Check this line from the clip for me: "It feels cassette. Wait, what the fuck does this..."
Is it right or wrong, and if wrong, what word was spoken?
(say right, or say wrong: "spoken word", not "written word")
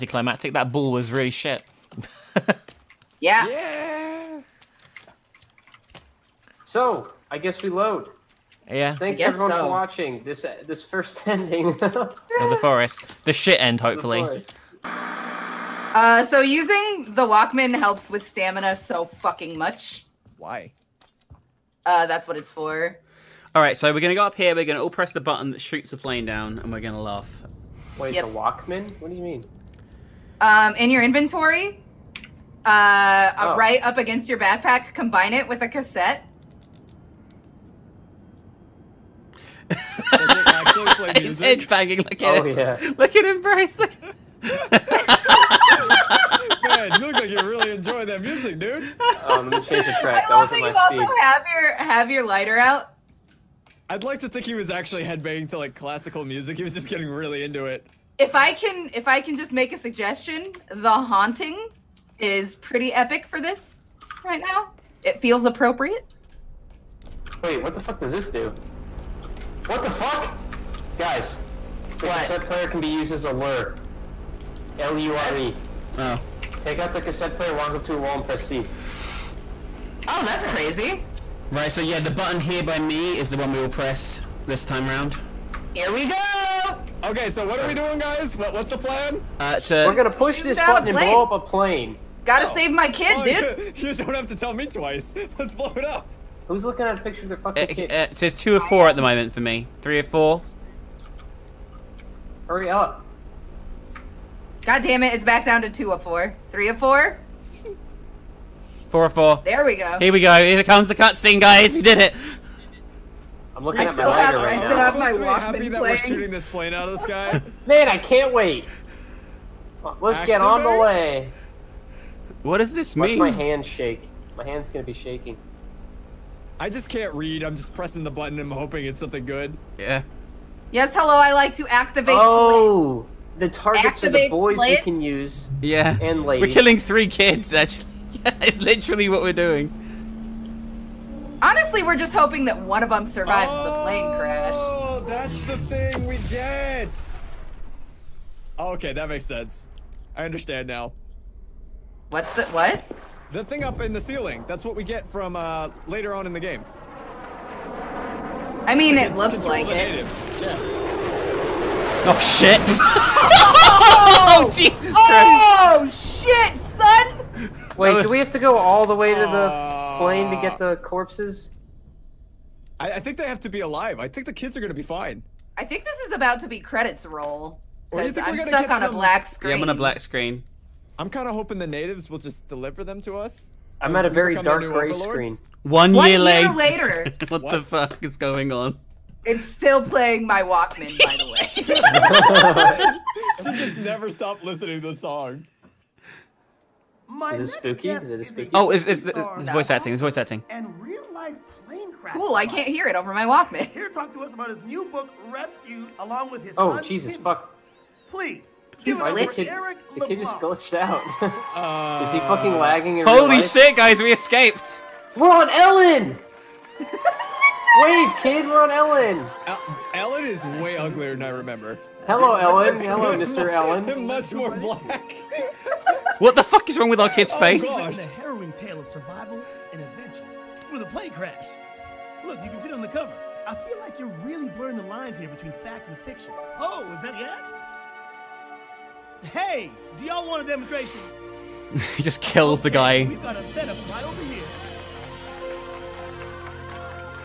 wrong: "appropriate", not "cassette".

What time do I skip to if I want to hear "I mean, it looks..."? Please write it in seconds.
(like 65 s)
158 s.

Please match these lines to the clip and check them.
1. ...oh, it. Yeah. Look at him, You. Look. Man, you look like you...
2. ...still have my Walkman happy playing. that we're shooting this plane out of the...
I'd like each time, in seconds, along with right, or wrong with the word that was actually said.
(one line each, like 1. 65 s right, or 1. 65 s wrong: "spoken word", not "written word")
1. 42 s wrong: "Bryce", not "You"
2. 114 s right.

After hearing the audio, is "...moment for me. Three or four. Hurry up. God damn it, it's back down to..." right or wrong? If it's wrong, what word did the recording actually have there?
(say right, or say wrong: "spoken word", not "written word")
right.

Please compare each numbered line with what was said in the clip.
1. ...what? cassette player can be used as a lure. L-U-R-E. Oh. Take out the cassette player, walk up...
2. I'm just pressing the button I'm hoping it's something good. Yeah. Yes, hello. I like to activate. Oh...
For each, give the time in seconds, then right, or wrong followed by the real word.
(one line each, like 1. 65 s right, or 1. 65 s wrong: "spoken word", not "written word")
1. 72 s right
2. 127 s right.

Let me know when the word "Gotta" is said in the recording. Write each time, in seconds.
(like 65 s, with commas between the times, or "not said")
92 s.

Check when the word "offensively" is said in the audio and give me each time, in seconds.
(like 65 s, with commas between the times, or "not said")
not said.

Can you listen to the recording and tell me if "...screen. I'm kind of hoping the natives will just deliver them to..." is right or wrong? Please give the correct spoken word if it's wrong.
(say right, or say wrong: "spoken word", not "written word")
right.